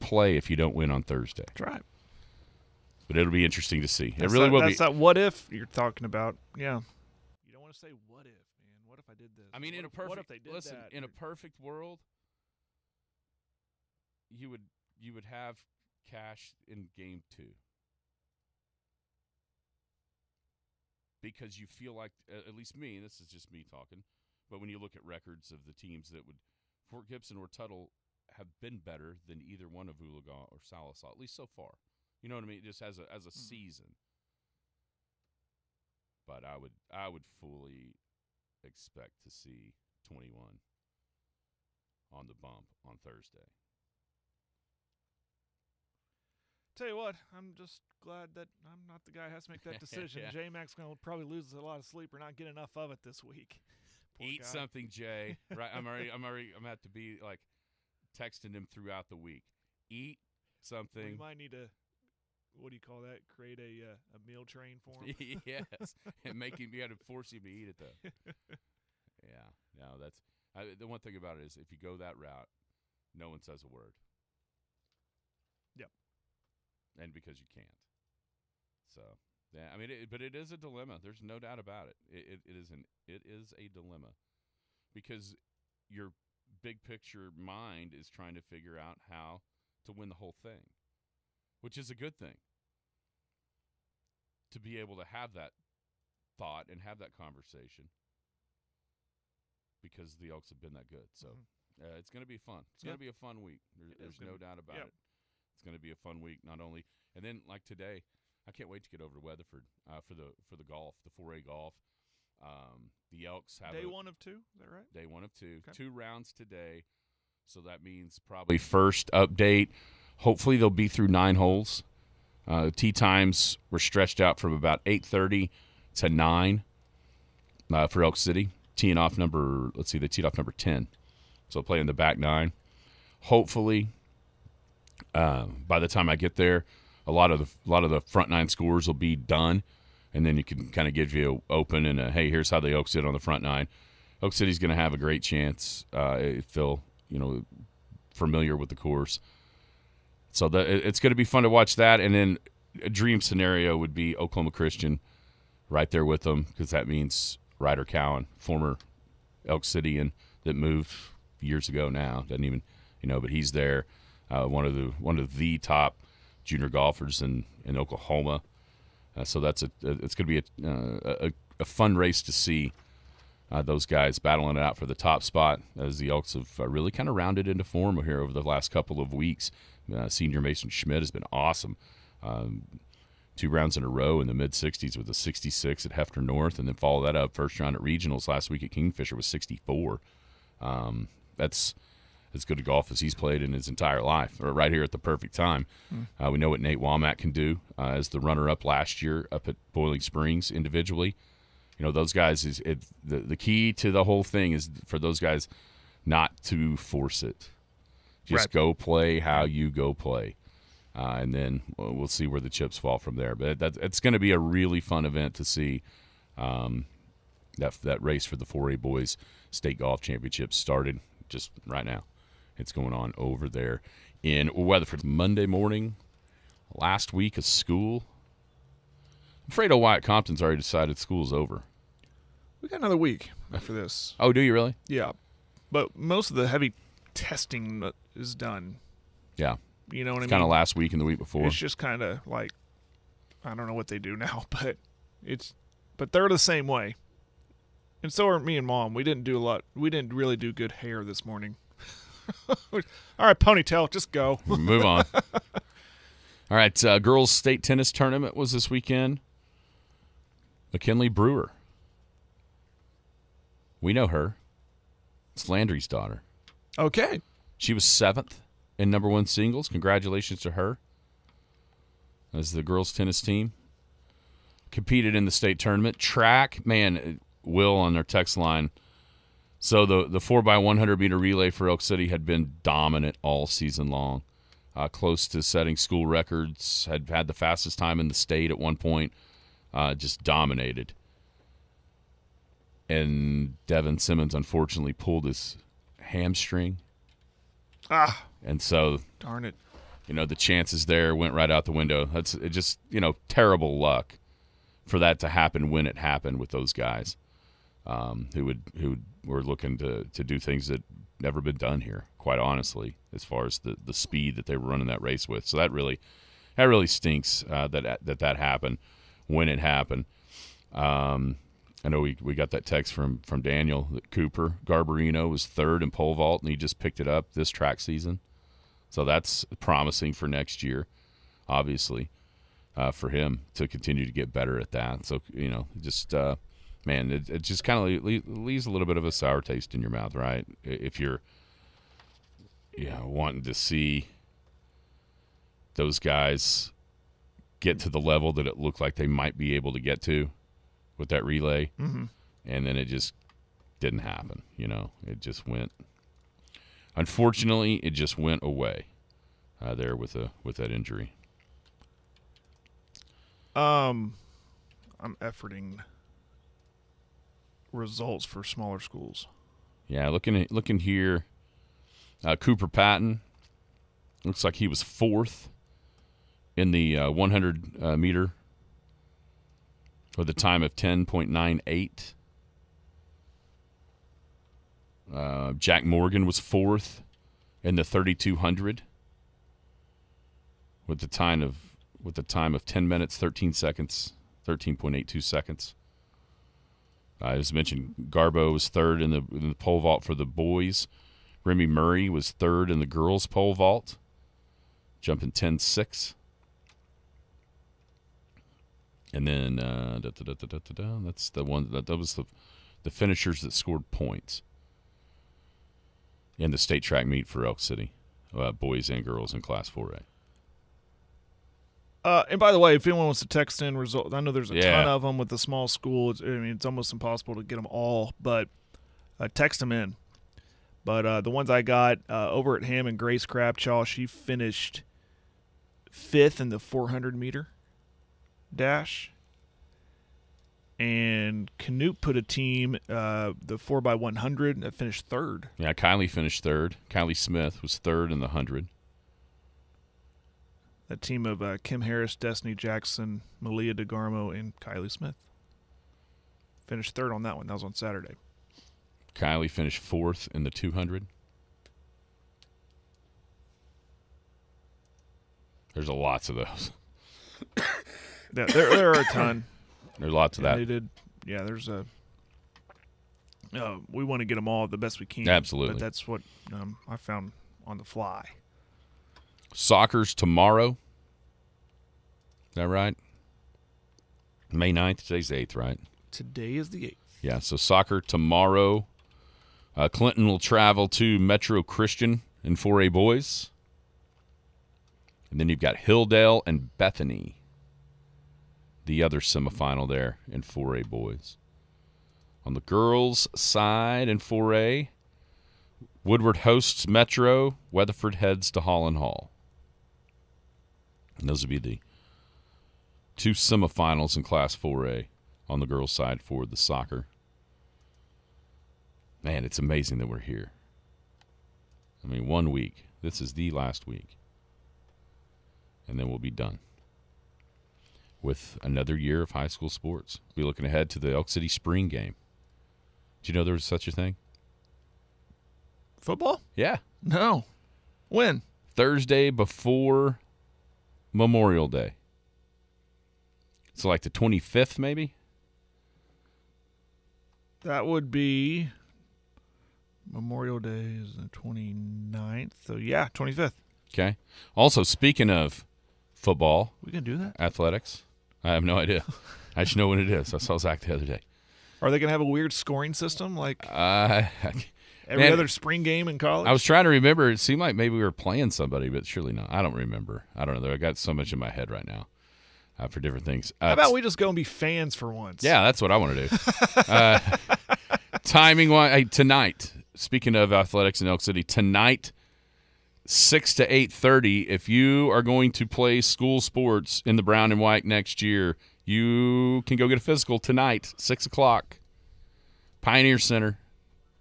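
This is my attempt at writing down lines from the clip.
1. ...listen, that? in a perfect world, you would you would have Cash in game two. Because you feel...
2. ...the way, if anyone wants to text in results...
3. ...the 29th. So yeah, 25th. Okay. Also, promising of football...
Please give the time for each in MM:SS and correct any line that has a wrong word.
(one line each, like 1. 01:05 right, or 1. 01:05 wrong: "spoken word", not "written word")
1. 00:10 right
2. 07:02 right
3. 09:11 wrong: "speaking", not "promising".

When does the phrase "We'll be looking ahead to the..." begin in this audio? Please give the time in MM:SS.
08:50.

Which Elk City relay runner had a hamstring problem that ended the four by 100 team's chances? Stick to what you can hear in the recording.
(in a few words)
Devin Simmons.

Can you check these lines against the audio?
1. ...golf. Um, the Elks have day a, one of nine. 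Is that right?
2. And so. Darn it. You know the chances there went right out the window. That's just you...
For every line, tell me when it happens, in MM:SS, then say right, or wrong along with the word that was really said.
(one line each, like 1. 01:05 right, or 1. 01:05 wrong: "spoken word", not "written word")
1. 01:51 wrong: "two", not "nine"
2. 04:58 right.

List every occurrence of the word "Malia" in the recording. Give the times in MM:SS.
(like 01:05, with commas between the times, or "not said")
07:33.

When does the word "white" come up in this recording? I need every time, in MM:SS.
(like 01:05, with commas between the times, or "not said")
09:47.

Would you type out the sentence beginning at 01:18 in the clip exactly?
So yeah, I mean, it, but it is a dilemma.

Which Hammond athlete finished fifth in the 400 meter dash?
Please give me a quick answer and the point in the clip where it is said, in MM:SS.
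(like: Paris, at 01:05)
Grace Crabshaw, at 07:12.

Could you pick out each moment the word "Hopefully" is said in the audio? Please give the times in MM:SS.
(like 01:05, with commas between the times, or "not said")
02:00, 02:13.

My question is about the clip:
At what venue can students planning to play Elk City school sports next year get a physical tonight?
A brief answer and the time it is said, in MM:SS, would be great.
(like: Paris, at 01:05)
Pioneer Center, at 09:52.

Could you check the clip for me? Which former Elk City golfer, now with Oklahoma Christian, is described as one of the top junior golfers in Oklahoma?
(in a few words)
Ryder Cowan.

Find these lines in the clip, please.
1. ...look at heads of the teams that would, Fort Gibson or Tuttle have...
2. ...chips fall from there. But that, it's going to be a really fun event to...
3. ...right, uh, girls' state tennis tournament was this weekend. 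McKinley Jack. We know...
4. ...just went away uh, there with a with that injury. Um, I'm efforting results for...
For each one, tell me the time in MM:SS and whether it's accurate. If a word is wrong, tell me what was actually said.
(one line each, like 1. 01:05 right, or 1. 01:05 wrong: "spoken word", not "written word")
1. 00:24 wrong: "records", not "heads"
2. 03:32 right
3. 04:16 wrong: "Brewer", not "Jack"
4. 05:57 right.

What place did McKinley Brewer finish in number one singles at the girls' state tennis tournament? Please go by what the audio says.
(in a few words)
7th.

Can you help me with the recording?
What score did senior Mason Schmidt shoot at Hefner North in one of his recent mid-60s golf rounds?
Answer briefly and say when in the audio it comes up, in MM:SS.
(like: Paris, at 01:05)
66, at 03:05.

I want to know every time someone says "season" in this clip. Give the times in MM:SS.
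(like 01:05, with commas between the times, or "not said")
00:33, 04:43, 05:27.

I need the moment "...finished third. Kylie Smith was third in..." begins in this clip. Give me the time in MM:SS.
07:26.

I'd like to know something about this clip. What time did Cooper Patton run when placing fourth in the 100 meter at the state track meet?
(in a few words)
10.98.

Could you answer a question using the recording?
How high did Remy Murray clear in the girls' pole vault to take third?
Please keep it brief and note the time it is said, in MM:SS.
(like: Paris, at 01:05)
10 6, at 06:45.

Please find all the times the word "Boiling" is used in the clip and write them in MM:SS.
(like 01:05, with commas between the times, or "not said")
03:19.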